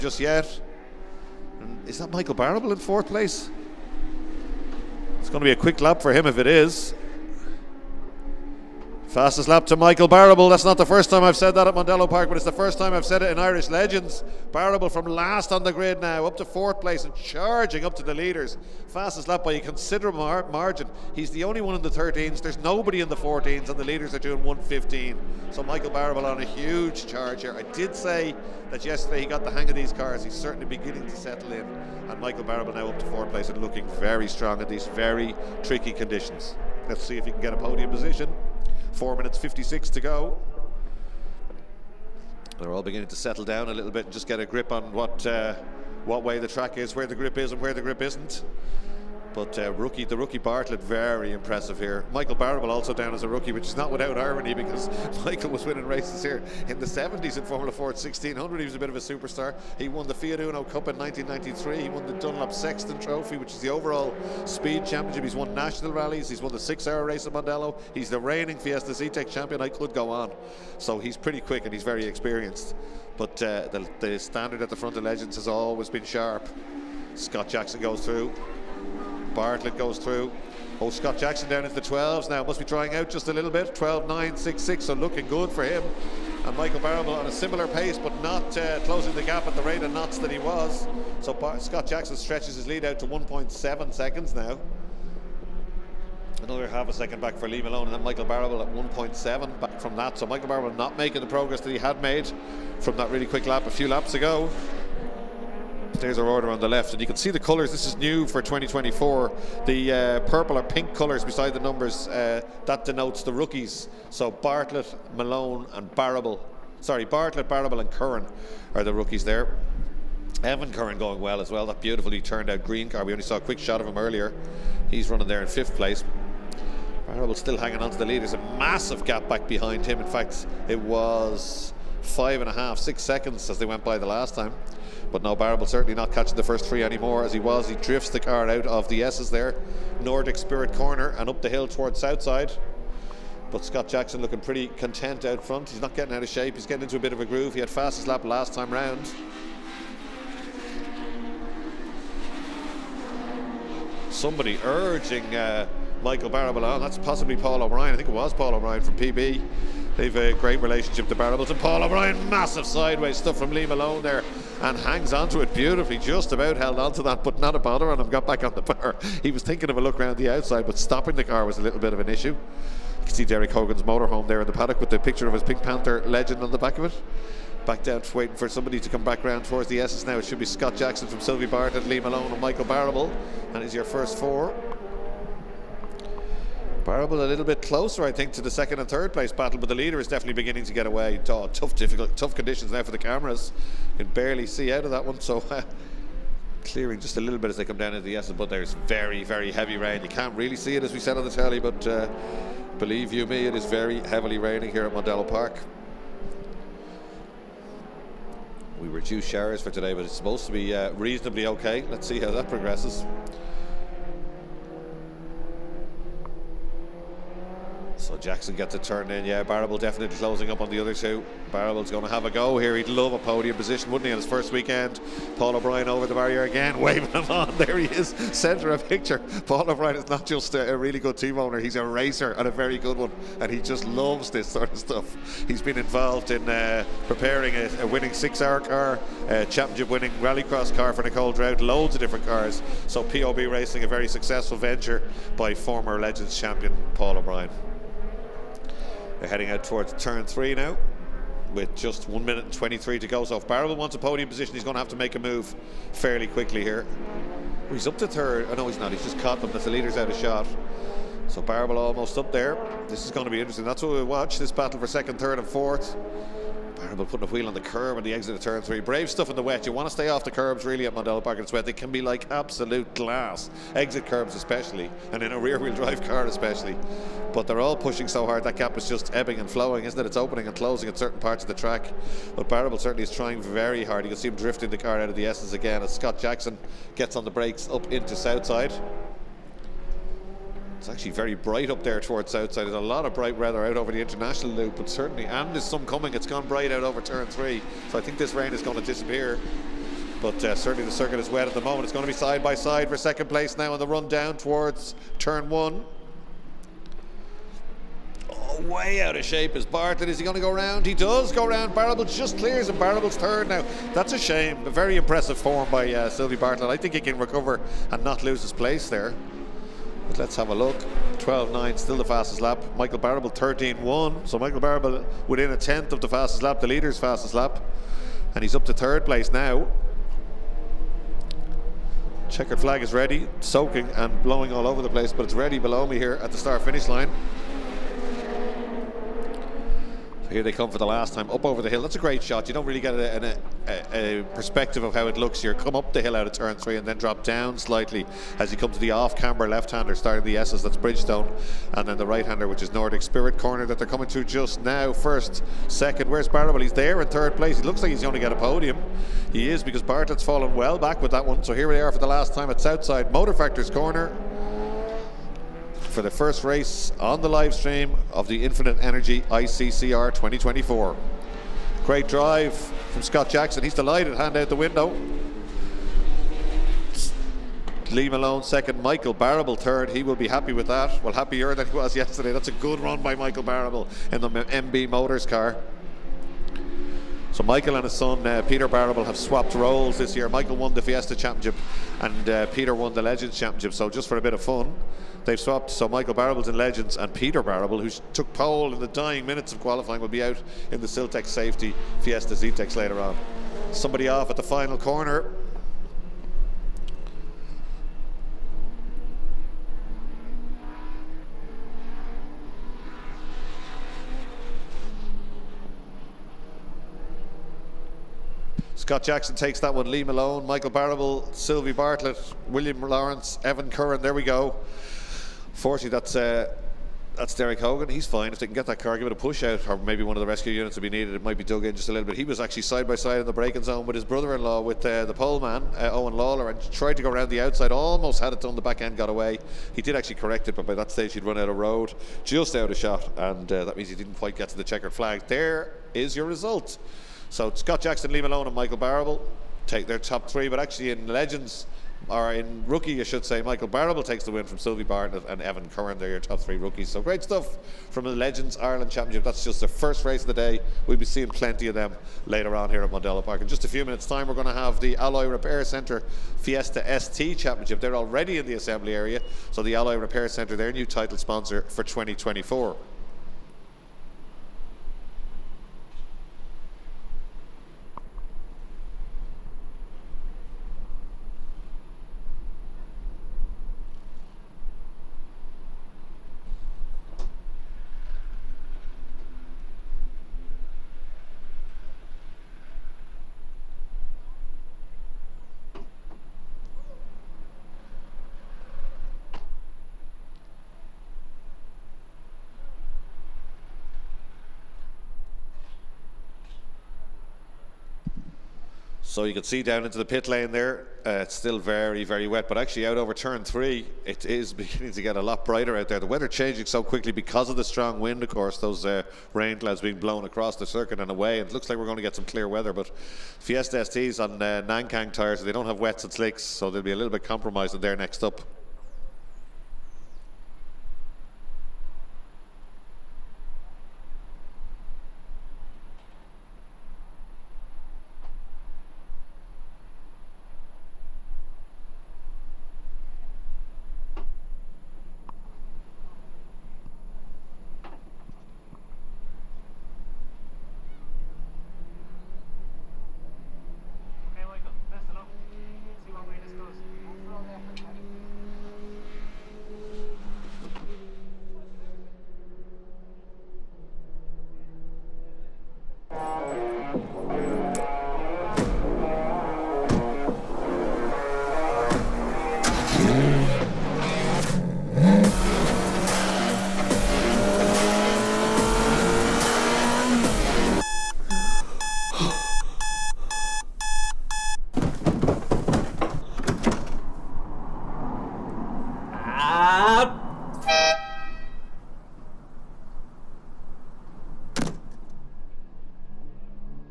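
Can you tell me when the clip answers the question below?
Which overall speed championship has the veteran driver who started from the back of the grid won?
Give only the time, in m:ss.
1:02.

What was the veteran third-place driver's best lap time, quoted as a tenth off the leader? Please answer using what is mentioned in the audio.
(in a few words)
13.1.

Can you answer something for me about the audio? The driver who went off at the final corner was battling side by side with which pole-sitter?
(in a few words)
Owen Lawler.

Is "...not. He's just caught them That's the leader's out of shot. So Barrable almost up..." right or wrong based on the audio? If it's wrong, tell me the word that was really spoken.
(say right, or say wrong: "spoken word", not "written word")
right.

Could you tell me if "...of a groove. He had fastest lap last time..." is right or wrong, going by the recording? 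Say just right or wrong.
right.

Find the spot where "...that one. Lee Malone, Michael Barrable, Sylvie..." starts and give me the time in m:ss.
6:59.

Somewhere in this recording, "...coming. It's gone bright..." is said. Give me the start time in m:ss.
4:55.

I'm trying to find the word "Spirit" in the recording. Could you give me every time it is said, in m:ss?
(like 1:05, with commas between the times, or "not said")
2:20, 5:53.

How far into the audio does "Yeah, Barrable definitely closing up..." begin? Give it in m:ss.
3:39.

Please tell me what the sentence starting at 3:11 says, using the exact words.
Oh, tough, difficult, tough conditions now for the cameras.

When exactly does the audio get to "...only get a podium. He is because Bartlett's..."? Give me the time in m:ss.
5:58.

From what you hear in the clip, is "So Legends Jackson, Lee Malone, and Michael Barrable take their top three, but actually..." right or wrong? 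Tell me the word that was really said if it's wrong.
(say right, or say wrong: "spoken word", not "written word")
wrong: "Scott", not "Legends".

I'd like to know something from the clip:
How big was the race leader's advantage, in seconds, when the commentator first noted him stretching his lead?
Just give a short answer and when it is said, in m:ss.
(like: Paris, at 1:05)
1.7 seconds, at 1:33.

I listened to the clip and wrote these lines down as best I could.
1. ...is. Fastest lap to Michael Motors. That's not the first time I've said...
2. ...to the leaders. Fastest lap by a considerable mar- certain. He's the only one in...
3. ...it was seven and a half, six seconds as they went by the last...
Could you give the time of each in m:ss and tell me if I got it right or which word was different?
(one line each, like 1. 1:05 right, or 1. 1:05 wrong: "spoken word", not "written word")
1. 0:06 wrong: "Barrable", not "Motors"
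2. 0:17 wrong: "margin", not "certain"
3. 2:10 wrong: "five", not "seven".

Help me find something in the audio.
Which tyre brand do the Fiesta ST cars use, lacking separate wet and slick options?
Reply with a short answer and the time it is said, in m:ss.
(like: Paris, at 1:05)
Nankang, at 8:44.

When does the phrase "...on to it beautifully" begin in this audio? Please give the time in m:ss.
2:45.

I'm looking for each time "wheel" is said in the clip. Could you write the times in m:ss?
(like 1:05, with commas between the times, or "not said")
4:27, 4:35.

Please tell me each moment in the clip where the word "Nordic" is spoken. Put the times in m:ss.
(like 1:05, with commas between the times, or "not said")
2:19, 5:52.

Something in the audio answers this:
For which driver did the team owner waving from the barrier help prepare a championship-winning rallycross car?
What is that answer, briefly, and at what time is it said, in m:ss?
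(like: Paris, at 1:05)
Nicole Drought, at 4:01.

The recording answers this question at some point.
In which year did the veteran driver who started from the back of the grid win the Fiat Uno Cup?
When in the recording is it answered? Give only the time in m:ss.
1:00.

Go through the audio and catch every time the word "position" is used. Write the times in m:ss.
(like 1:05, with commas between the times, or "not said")
0:37, 3:43, 4:14.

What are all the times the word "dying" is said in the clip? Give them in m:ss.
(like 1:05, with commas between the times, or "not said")
6:38.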